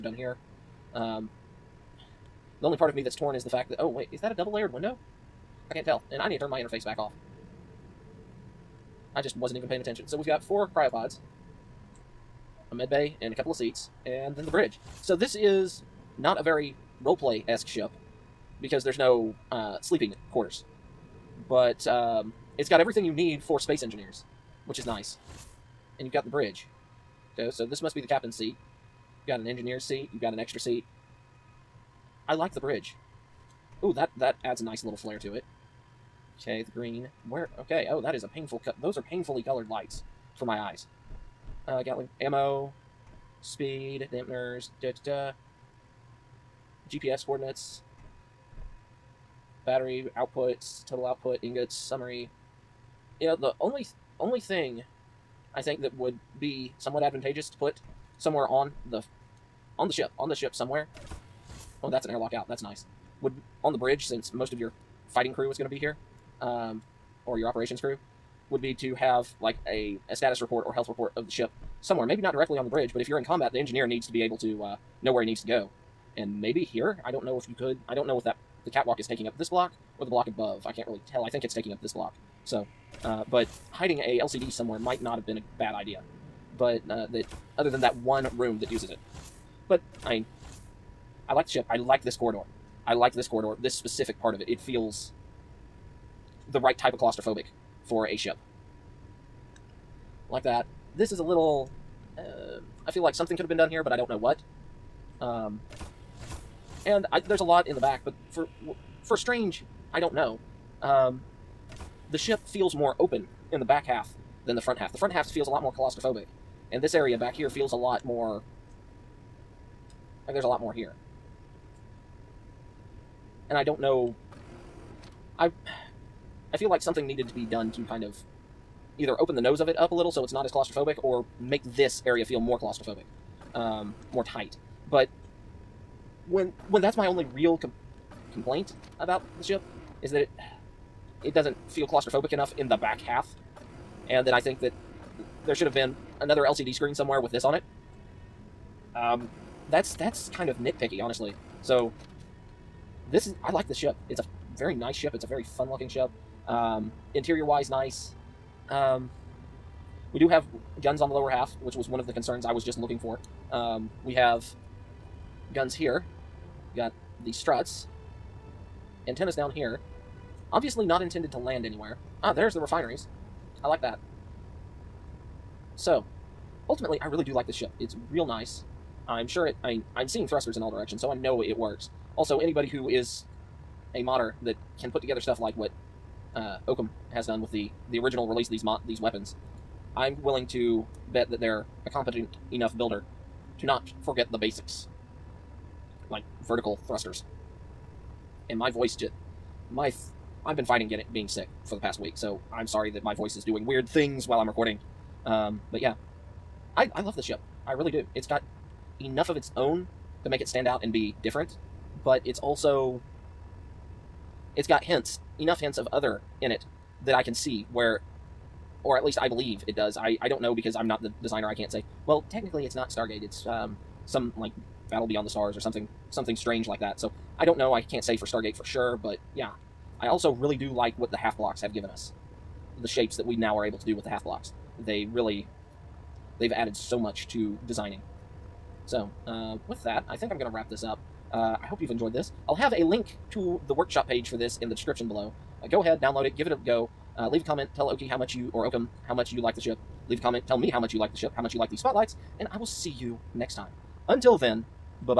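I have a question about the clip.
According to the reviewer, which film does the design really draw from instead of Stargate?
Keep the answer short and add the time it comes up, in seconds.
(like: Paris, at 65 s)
Battle Beyond the Stars, at 224 s.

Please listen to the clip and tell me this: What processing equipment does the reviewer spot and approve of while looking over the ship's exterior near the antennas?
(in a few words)
Refineries.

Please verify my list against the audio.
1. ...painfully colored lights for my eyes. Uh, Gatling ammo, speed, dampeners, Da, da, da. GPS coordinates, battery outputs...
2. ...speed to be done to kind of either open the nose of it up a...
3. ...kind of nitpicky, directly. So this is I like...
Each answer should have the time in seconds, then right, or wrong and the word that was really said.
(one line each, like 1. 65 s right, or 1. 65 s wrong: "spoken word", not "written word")
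1. 39 s right
2. 127 s wrong: "needed", not "speed"
3. 150 s wrong: "honestly", not "directly".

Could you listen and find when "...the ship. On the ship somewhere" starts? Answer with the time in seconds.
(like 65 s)
59 s.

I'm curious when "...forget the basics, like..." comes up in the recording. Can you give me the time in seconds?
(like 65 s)
194 s.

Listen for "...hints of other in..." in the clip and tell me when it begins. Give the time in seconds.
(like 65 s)
215 s.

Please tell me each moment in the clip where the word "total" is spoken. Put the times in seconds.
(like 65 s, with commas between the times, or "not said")
50 s.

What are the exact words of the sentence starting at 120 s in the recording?
Like there's a lot more here.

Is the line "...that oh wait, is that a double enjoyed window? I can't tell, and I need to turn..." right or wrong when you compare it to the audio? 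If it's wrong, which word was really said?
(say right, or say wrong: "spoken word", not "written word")
wrong: "layered", not "enjoyed".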